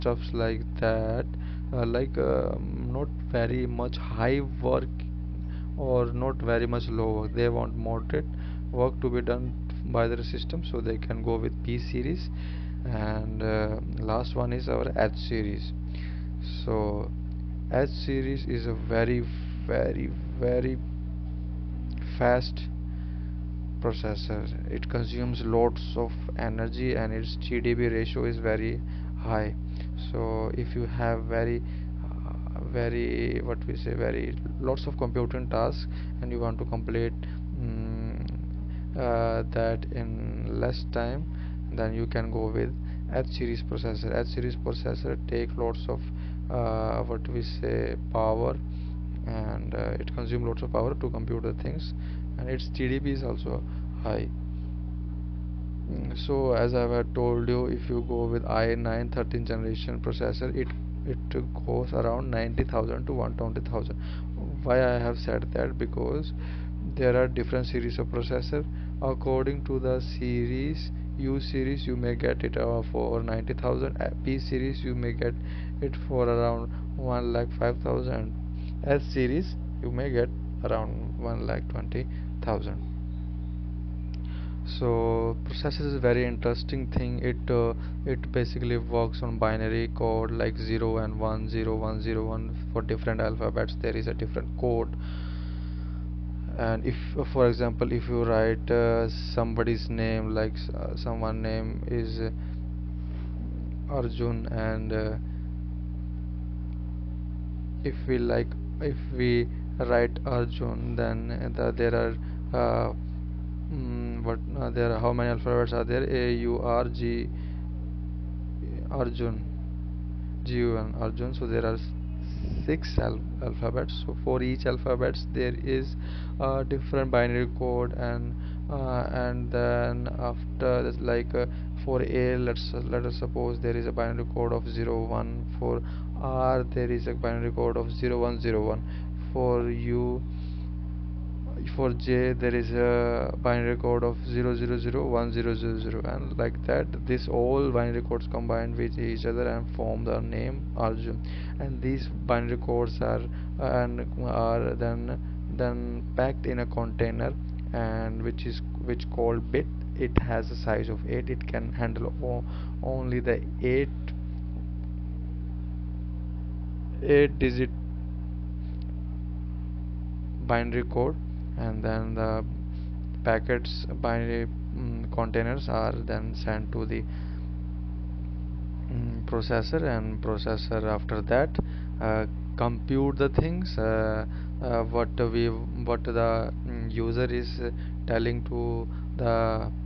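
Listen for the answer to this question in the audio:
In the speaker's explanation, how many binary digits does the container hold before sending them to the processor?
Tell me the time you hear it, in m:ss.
2:39.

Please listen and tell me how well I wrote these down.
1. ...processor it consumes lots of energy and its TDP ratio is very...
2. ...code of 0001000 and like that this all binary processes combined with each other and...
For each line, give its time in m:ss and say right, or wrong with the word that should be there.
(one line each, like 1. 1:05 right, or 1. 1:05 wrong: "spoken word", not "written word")
1. 0:23 right
2. 2:23 wrong: "codes", not "processes".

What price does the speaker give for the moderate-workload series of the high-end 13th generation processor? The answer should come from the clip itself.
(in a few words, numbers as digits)
1 lakh 5000.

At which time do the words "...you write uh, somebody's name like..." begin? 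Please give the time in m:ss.
1:38.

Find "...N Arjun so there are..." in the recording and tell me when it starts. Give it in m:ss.
2:00.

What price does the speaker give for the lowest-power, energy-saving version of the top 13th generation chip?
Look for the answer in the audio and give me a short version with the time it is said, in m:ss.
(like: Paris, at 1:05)
90,000, at 1:11.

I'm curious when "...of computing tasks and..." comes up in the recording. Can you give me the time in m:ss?
0:34.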